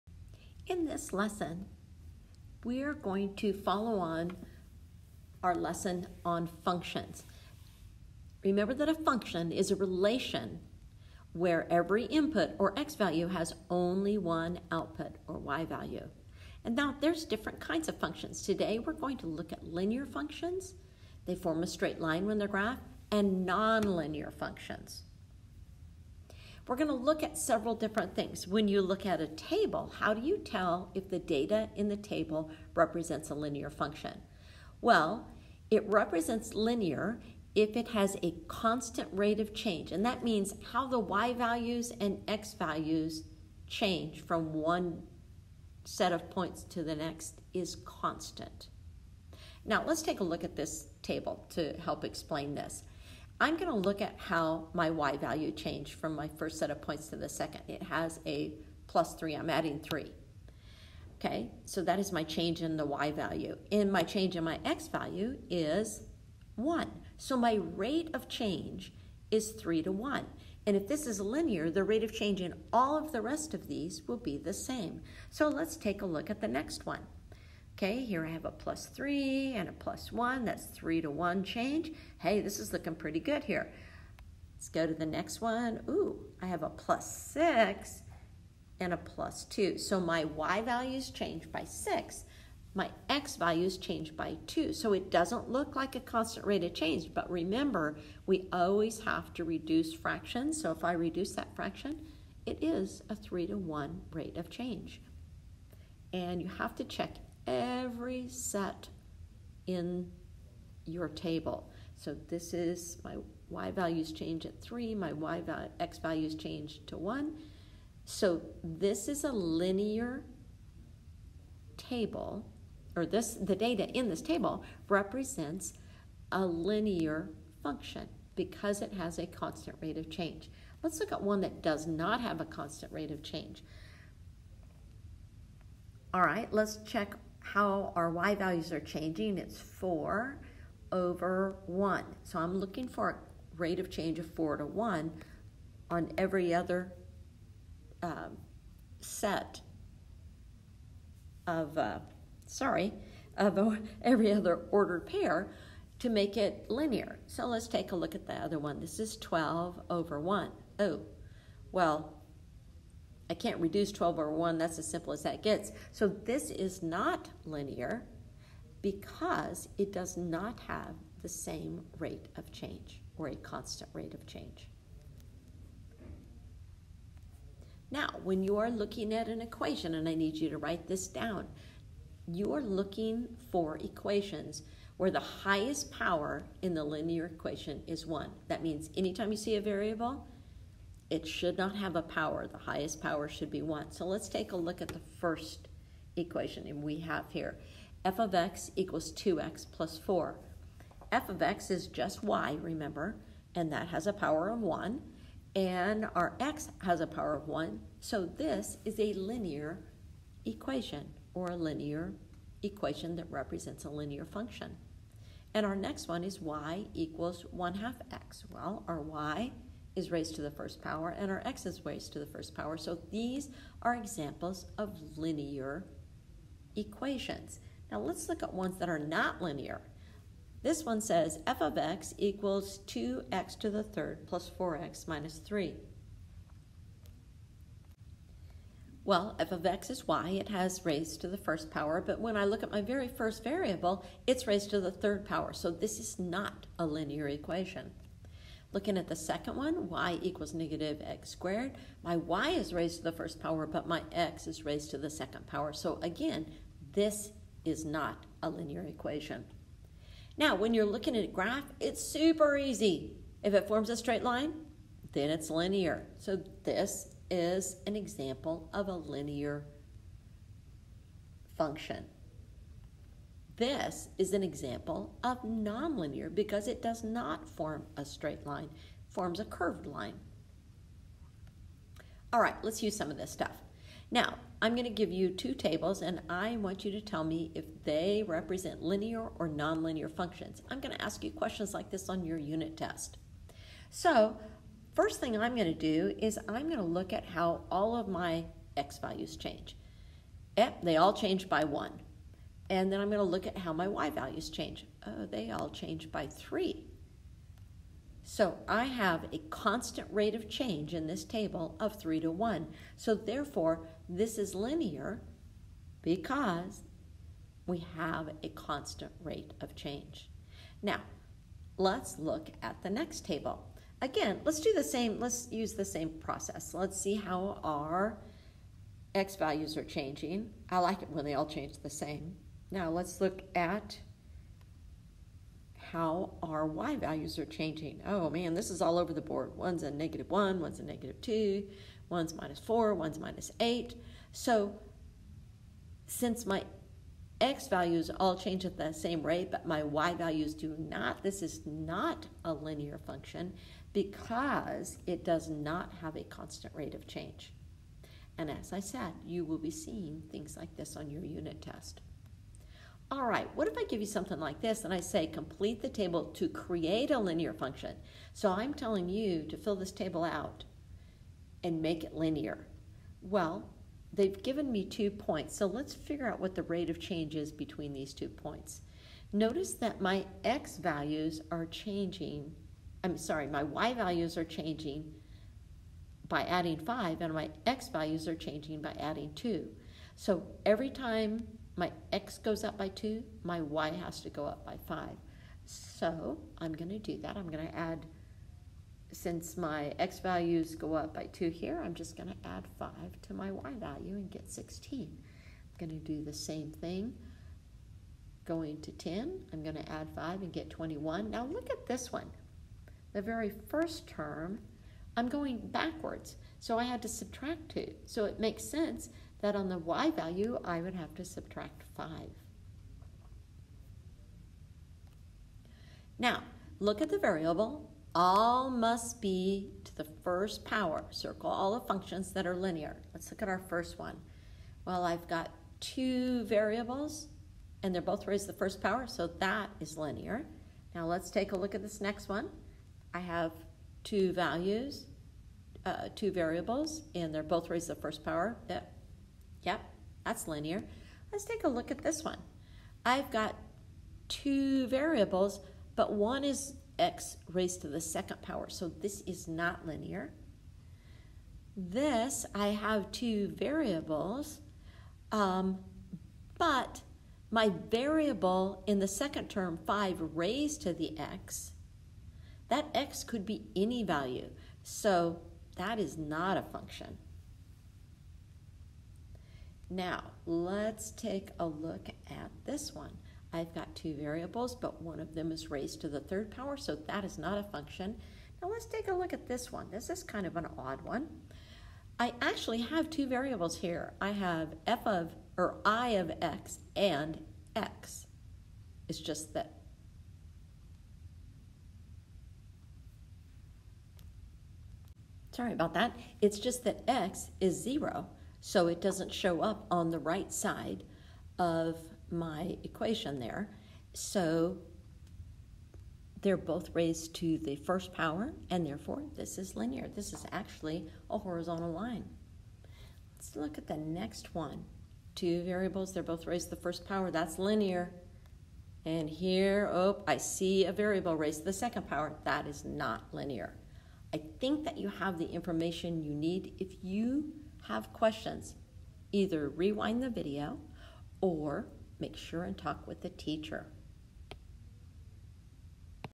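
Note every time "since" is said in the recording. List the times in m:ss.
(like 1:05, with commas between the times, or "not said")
5:46, 6:39.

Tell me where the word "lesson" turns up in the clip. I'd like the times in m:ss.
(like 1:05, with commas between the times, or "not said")
0:01, 0:05.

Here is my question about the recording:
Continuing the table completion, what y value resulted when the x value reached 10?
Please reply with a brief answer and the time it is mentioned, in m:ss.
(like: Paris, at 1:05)
21, at 6:50.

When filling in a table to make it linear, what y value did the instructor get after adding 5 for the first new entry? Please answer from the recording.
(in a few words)
16.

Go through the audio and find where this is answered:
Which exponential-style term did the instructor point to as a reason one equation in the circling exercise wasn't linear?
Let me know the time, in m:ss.
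7:49.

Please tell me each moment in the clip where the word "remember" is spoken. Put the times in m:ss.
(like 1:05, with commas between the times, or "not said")
0:08, 1:37, 3:22.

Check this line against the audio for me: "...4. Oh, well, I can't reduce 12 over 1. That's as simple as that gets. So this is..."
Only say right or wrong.
wrong.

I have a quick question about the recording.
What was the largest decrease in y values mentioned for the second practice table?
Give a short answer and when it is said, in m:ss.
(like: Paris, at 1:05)
minus 8, at 5:43.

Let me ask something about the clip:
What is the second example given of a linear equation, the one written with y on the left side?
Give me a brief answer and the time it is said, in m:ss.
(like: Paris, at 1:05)
y equals 1/2 x, at 3:36.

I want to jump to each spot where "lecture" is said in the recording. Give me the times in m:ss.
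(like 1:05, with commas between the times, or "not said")
not said.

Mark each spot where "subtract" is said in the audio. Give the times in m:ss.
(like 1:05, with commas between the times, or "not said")
6:57, 7:01.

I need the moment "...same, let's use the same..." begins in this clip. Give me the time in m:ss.
5:24.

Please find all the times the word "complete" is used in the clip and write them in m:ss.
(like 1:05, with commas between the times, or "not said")
6:05.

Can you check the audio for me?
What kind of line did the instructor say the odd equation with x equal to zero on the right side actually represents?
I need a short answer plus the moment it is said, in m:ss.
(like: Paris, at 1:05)
horizontal line, at 8:41.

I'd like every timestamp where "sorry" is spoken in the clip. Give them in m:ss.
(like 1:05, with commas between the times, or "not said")
2:32, 6:23, 8:25.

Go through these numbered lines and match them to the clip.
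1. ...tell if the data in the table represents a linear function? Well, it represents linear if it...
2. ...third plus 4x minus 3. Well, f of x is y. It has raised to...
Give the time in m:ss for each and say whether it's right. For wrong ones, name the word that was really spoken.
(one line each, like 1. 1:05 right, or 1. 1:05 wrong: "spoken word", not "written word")
1. 0:30 right
2. 3:53 right.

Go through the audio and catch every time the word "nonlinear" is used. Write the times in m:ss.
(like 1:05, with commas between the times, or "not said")
0:23, 4:35, 4:49.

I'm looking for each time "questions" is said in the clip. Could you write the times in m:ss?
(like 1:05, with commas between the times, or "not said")
4:51, 8:58.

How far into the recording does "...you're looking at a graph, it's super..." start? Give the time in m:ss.
4:20.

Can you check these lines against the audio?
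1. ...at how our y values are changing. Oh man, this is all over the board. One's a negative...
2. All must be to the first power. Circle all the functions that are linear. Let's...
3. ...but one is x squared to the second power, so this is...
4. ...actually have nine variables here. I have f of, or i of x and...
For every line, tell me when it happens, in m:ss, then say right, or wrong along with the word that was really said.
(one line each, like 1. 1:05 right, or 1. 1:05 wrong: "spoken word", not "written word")
1. 5:33 right
2. 7:08 right
3. 7:35 wrong: "raised", not "squared"
4. 8:12 wrong: "two", not "nine".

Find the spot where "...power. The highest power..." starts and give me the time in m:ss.
3:12.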